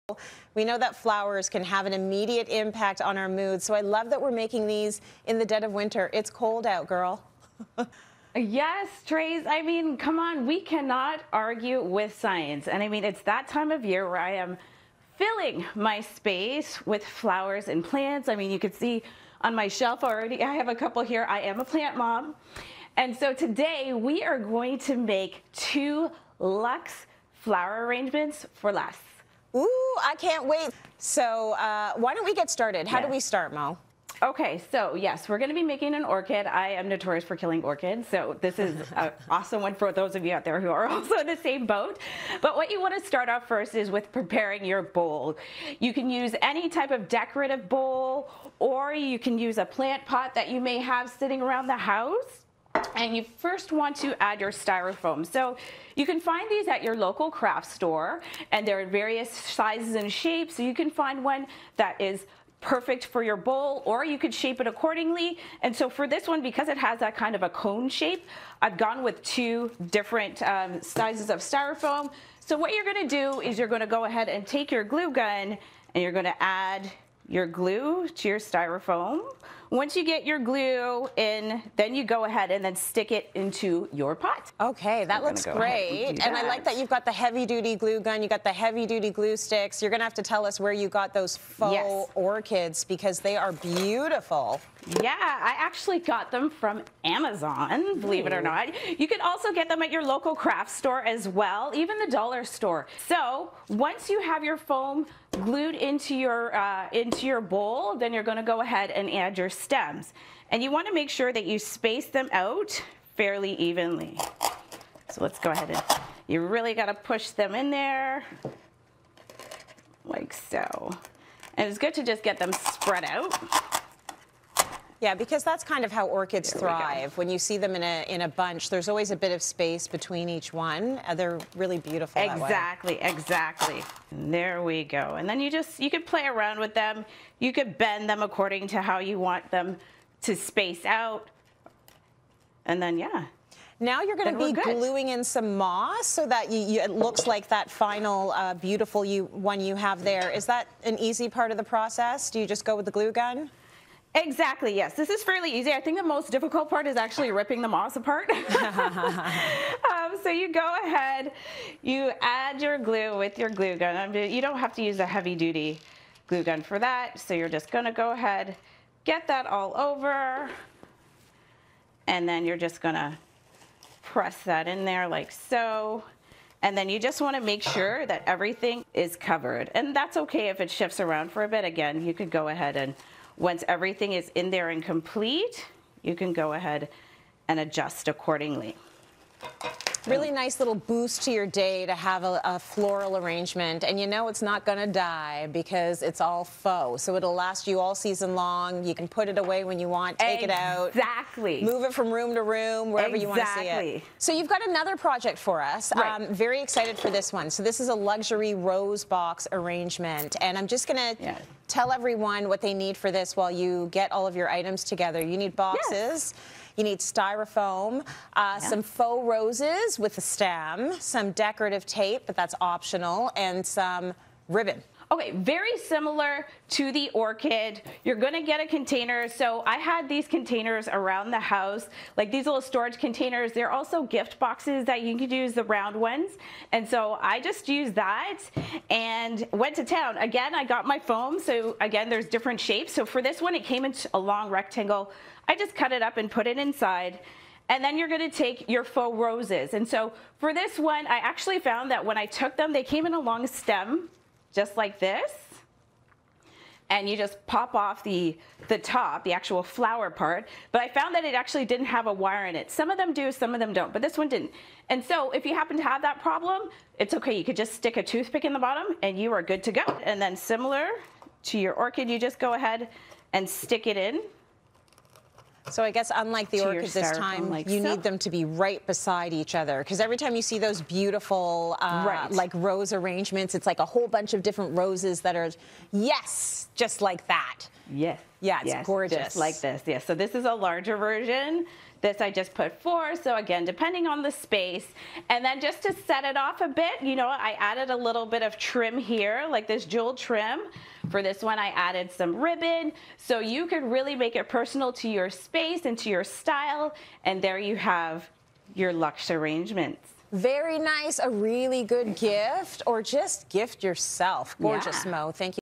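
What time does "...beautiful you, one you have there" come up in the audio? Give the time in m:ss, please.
2:28.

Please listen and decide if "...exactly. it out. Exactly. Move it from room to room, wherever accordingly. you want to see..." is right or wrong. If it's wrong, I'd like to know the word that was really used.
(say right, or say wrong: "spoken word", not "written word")
wrong: "exactly", not "accordingly".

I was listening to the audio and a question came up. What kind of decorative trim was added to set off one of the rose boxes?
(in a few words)
Jewel trim.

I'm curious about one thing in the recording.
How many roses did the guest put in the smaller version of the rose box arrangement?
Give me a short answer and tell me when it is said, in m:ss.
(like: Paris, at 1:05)
4, at 4:52.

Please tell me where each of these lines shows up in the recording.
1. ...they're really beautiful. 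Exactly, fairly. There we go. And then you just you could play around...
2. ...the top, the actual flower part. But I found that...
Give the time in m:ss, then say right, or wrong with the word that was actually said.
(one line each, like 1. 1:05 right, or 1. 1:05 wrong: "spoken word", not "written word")
1. 2:11 wrong: "exactly", not "fairly"
2. 4:18 right.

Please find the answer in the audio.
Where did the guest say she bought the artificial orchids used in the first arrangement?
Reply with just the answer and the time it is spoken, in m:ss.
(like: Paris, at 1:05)
Amazon, at 1:37.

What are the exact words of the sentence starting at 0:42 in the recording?
But what you want to start off first is with preparing your bowl.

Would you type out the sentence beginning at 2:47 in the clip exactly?
So you're just gonna go ahead, get that all over, and then you're just gonna press that in there like so.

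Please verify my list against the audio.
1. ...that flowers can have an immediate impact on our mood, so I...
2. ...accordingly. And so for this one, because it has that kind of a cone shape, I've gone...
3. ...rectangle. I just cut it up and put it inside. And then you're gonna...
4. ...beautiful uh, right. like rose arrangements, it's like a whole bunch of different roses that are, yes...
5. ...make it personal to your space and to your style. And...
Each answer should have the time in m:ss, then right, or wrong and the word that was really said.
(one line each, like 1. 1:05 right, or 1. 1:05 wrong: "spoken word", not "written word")
1. 0:00 right
2. 1:04 right
3. 4:04 right
4. 4:40 right
5. 5:04 right.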